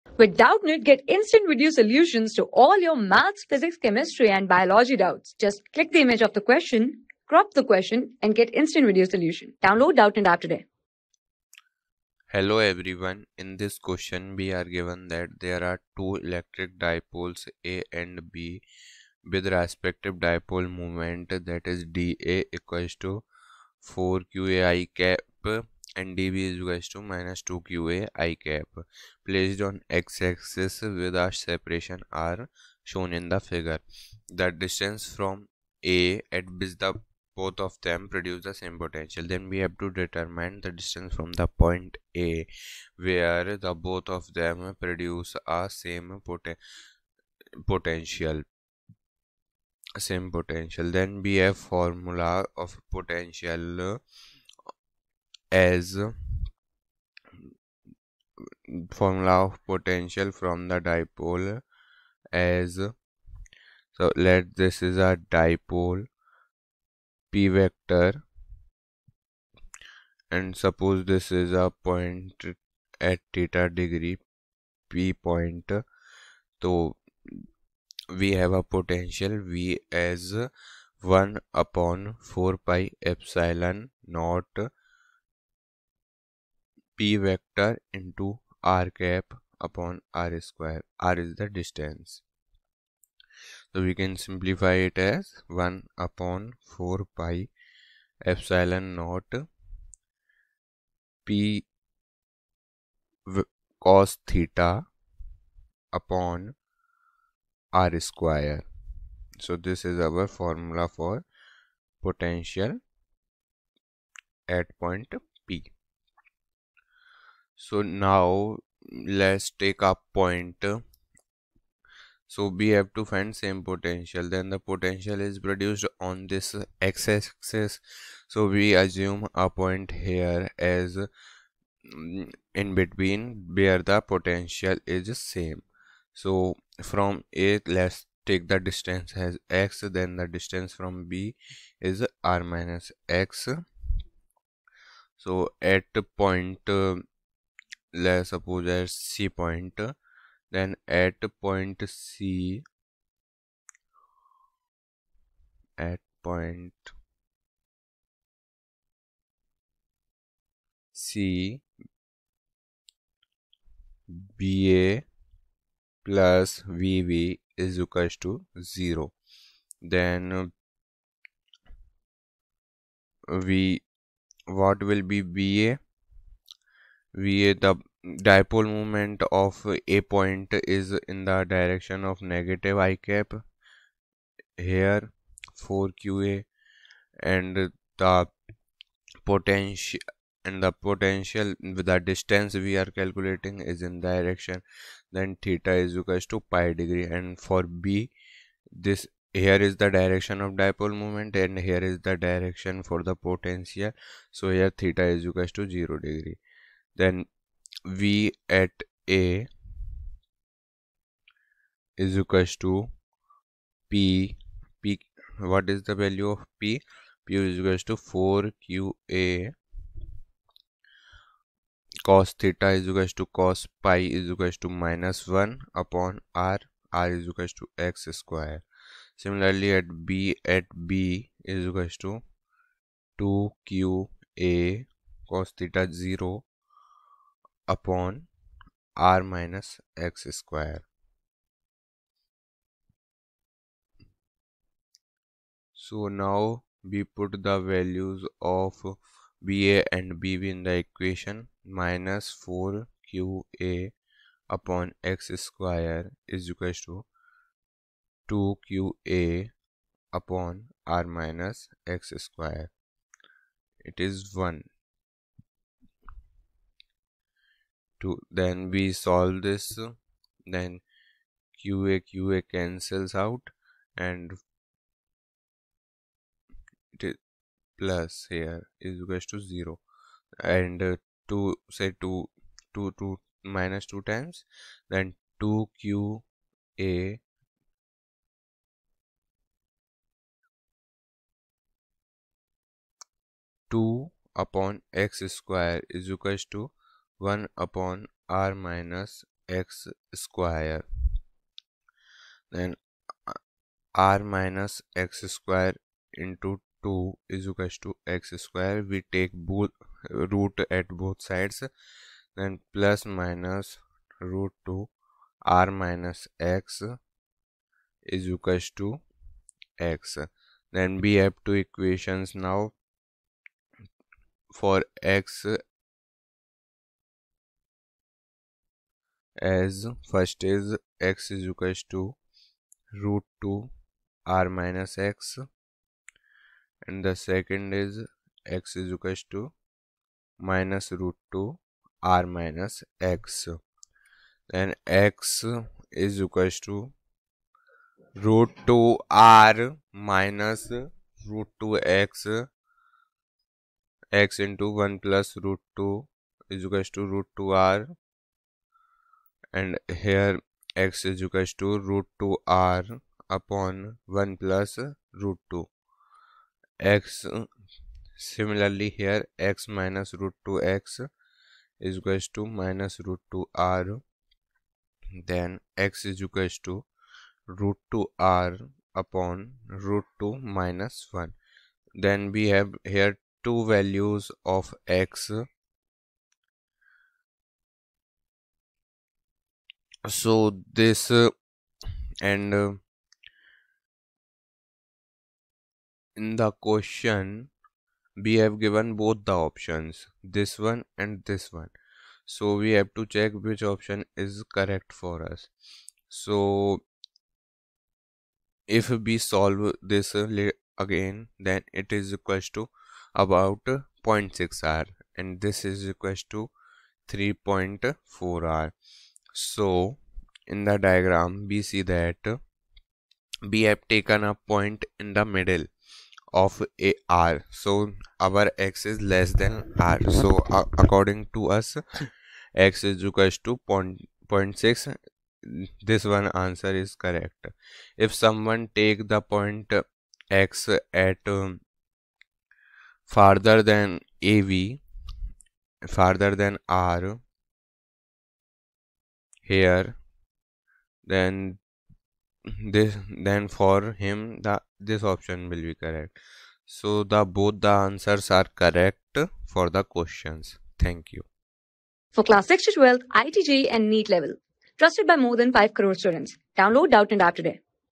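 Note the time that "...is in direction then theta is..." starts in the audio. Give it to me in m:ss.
3:13.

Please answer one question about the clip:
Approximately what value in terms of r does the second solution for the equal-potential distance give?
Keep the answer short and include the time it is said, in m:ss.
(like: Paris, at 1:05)
3.4r, at 6:57.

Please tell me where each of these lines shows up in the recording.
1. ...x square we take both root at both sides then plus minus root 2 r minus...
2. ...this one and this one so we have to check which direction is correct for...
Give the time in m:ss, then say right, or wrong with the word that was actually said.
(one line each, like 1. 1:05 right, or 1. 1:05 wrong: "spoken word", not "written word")
1. 5:08 right
2. 6:40 wrong: "option", not "direction".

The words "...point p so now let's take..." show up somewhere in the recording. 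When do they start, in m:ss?
1:54.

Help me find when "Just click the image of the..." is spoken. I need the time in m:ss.
0:05.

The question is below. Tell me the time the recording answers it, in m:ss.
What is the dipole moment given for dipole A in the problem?
0:21.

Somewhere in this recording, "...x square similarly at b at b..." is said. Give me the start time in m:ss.
3:47.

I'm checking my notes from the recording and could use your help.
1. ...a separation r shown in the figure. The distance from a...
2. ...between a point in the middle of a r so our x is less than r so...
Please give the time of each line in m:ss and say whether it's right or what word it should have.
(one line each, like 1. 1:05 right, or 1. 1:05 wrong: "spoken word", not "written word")
1. 0:31 right
2. 7:03 wrong: "taken", not "between".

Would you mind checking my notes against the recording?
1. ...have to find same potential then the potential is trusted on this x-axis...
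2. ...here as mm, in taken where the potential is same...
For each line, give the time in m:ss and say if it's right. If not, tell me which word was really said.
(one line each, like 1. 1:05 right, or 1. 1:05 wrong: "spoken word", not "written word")
1. 2:02 wrong: "produced", not "trusted"
2. 2:09 wrong: "between", not "taken".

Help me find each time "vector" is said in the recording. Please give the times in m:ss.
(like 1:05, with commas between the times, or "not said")
1:07, 1:27.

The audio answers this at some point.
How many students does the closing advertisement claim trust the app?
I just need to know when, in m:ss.
7:45.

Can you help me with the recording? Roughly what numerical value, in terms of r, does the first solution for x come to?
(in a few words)
0.6r.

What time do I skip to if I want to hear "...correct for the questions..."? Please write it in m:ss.
7:38.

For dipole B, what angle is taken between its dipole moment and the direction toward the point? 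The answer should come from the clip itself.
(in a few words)
0 degrees.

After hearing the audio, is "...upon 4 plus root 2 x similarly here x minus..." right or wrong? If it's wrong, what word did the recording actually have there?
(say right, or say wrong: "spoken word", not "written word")
wrong: "1", not "4".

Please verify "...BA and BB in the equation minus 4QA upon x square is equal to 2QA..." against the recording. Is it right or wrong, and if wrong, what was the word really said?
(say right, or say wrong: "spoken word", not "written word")
right.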